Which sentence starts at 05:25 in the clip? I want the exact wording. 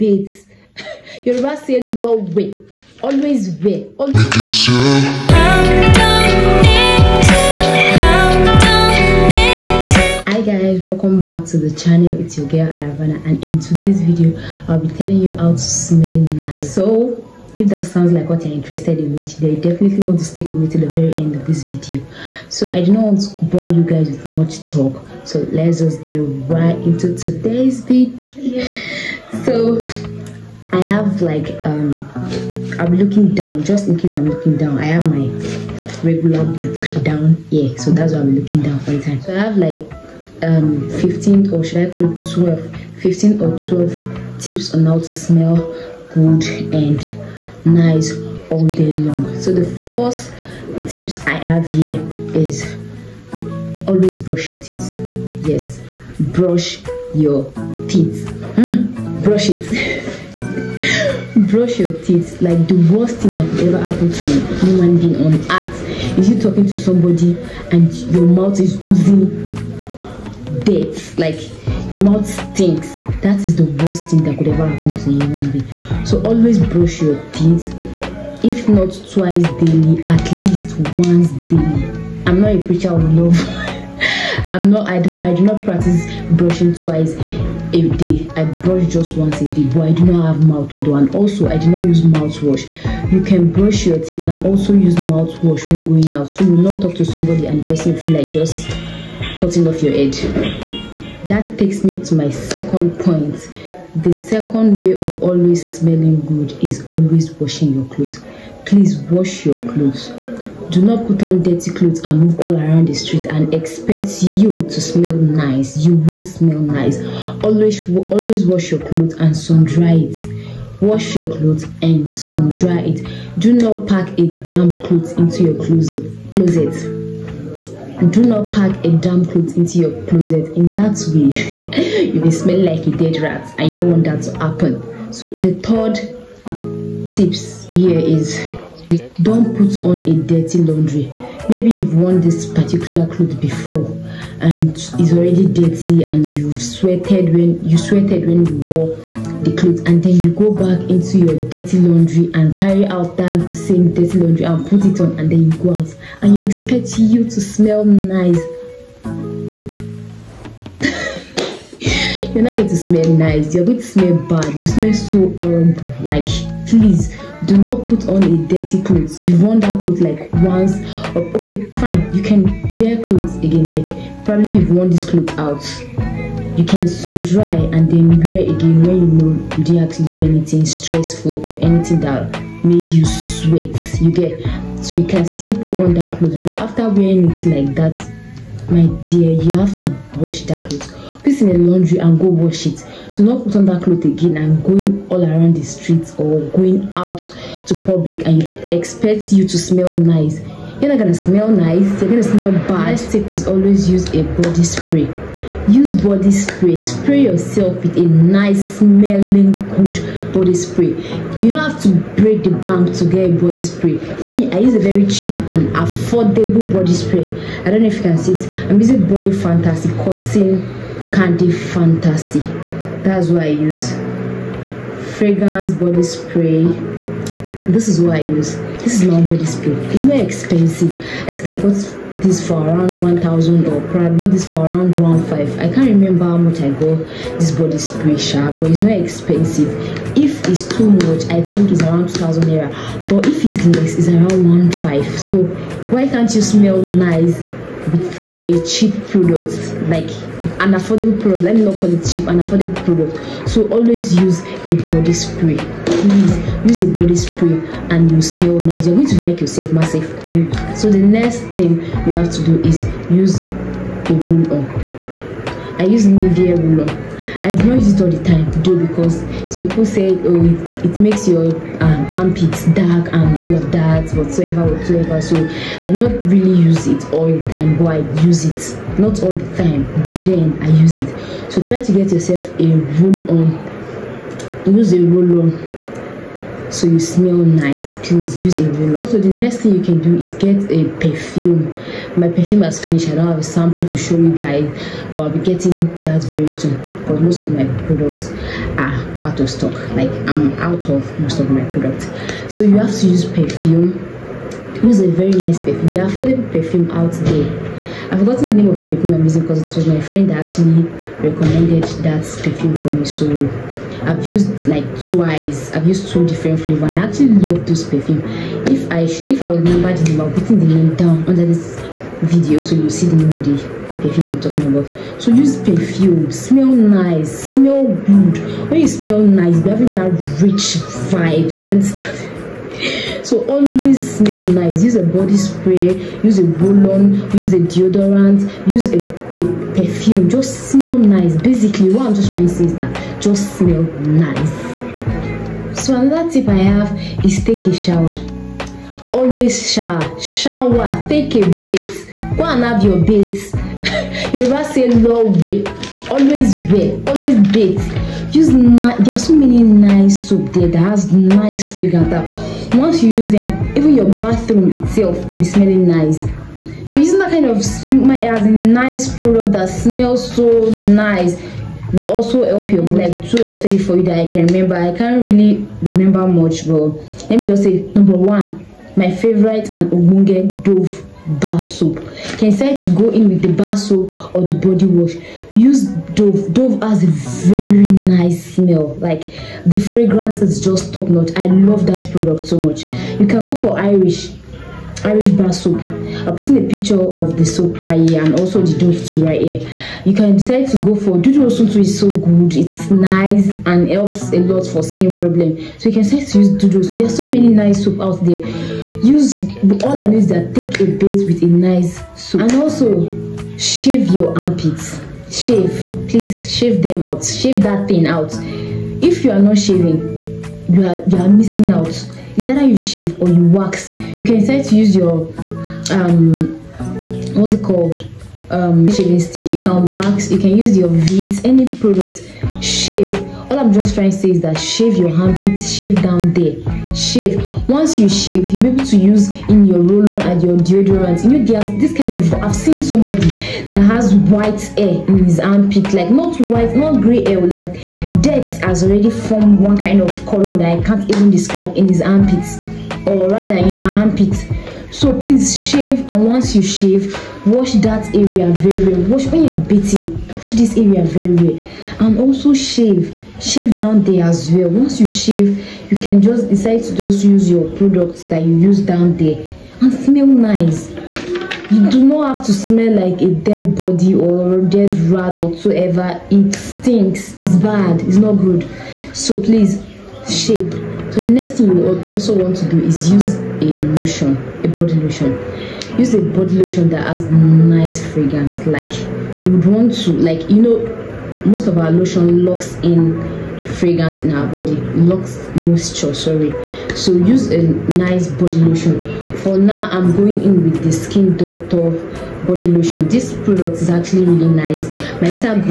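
So use perfume, smell nice, smell good.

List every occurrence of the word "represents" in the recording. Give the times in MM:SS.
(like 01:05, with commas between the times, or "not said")
not said.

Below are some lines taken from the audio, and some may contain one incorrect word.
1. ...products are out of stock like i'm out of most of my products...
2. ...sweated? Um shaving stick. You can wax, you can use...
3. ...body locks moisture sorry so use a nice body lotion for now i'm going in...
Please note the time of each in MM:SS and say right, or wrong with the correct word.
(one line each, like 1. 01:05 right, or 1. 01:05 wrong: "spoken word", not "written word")
1. 04:57 right
2. 07:07 wrong: "called", not "sweated"
3. 08:14 right.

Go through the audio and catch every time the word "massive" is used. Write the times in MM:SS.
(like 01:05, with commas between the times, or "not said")
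04:19.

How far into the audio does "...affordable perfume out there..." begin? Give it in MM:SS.
05:05.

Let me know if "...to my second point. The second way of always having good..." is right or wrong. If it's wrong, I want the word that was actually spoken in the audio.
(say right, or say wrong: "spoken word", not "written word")
wrong: "smelling", not "having".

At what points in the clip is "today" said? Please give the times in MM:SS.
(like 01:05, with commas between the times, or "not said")
00:13, 00:27.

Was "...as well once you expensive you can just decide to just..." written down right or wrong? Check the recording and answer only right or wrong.
wrong.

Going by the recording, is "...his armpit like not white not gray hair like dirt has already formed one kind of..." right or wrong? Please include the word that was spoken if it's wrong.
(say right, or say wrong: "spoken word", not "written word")
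right.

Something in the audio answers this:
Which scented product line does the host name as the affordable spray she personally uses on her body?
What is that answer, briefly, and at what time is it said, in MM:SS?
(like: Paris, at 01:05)
Body Fantasy cotton candy, at 03:39.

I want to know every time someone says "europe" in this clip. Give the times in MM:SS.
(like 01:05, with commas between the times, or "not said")
not said.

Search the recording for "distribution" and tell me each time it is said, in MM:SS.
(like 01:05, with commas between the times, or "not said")
not said.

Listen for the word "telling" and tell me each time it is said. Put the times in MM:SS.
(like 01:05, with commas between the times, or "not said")
00:14.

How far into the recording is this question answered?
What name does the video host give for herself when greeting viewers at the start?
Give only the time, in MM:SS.
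00:12.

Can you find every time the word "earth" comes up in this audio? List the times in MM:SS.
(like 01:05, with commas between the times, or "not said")
01:05.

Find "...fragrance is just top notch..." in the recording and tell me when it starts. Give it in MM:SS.
06:29.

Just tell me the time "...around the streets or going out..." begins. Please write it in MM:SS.
03:15.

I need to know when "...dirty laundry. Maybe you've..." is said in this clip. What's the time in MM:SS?
02:20.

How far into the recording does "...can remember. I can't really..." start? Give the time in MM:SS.
06:14.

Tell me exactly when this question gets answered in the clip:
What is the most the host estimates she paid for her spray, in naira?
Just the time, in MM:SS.
04:02.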